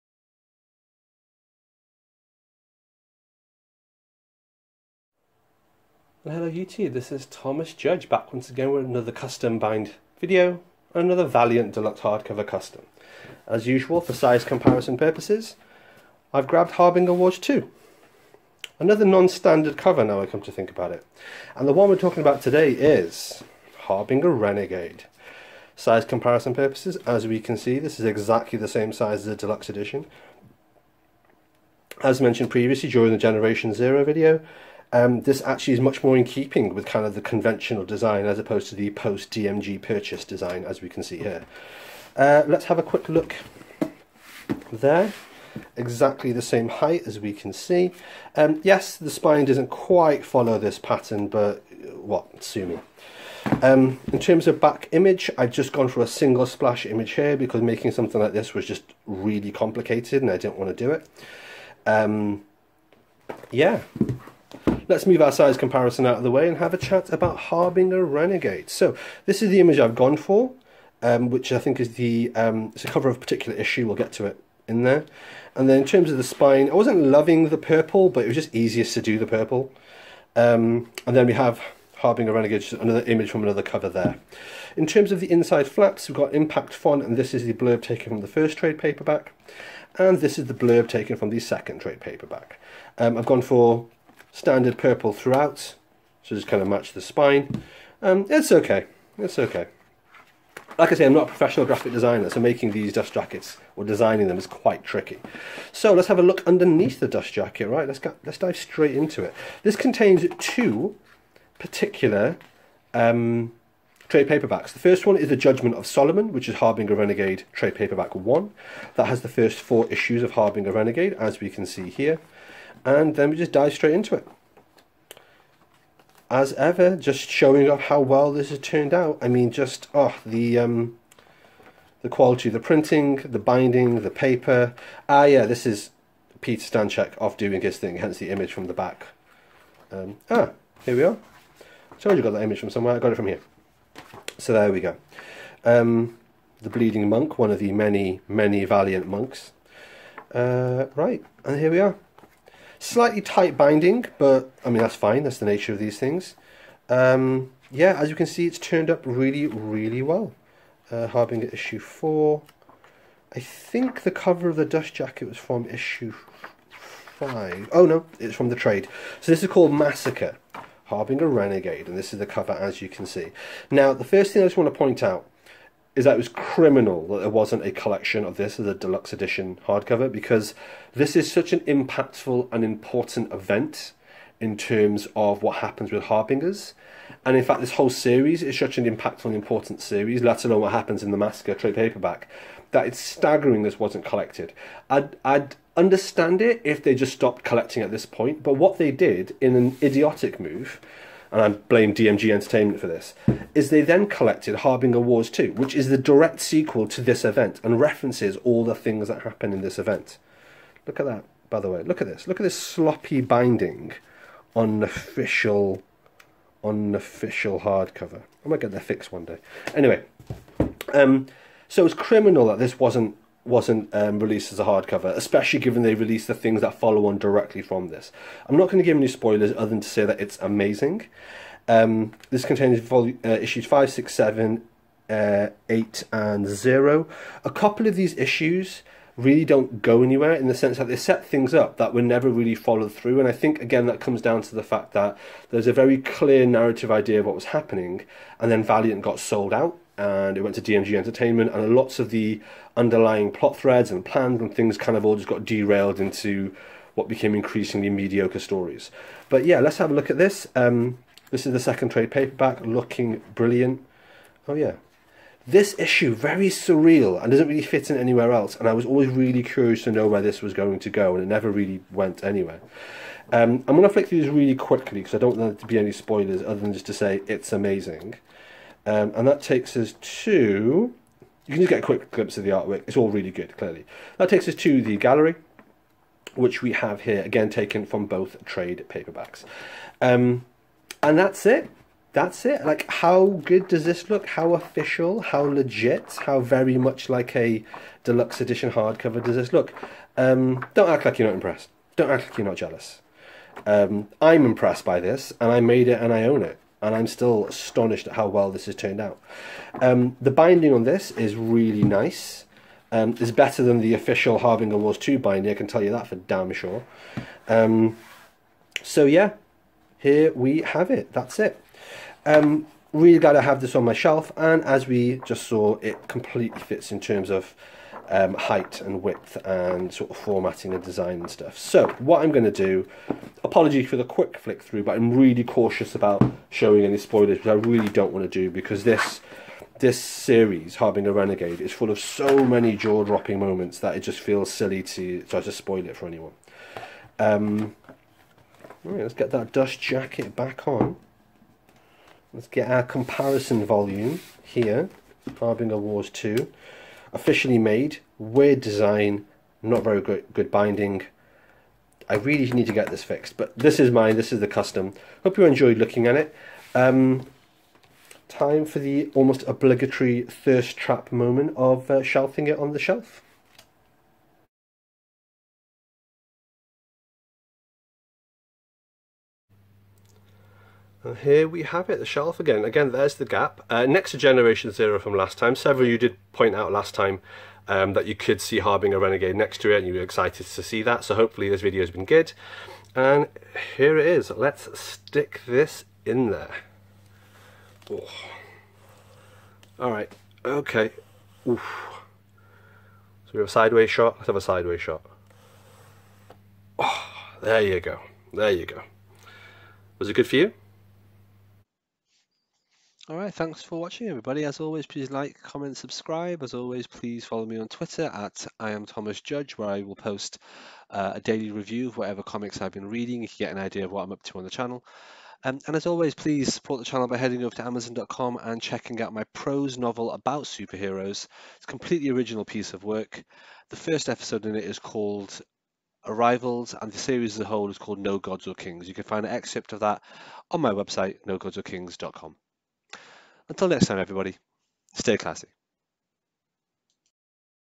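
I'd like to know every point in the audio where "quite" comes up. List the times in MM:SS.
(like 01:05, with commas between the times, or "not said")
00:49, 01:44.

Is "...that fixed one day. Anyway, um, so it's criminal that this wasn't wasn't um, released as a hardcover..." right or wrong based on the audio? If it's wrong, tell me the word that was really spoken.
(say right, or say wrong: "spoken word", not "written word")
right.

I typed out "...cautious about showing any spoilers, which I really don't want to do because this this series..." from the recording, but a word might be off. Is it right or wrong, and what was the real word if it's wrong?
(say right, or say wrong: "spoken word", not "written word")
right.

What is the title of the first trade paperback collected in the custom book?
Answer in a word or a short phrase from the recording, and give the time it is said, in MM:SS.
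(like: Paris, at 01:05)
The Judgment of Solomon, at 01:55.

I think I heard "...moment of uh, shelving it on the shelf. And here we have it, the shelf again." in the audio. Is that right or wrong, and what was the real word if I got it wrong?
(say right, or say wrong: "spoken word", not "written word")
right.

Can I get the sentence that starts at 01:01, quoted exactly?
Um, yeah, Let's move our size comparison out of the way and have a chat about Harbinger Renegade.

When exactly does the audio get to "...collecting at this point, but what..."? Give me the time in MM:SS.
03:17.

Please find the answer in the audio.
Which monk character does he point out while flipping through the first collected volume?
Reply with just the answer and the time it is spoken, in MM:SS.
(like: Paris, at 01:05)
The Bleeding Monk, at 02:26.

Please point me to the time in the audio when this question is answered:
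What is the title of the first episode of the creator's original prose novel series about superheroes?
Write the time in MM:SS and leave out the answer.
07:16.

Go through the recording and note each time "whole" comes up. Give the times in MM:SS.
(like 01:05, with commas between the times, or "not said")
03:07, 07:17.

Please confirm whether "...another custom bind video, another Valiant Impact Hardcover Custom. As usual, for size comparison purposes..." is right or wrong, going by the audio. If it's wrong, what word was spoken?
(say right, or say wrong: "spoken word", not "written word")
wrong: "Deluxe", not "Impact".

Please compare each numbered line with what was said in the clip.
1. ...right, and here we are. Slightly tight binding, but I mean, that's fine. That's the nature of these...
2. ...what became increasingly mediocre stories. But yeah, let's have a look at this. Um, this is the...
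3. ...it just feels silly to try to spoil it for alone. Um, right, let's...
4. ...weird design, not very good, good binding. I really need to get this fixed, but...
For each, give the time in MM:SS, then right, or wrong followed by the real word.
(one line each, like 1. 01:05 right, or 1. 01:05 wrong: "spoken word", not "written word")
1. 02:30 right
2. 04:16 right
3. 05:43 wrong: "anyone", not "alone"
4. 05:58 right.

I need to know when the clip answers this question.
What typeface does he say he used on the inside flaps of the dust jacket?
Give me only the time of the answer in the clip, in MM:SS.
01:26.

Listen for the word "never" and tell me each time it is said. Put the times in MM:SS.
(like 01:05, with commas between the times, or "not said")
04:02, 04:31.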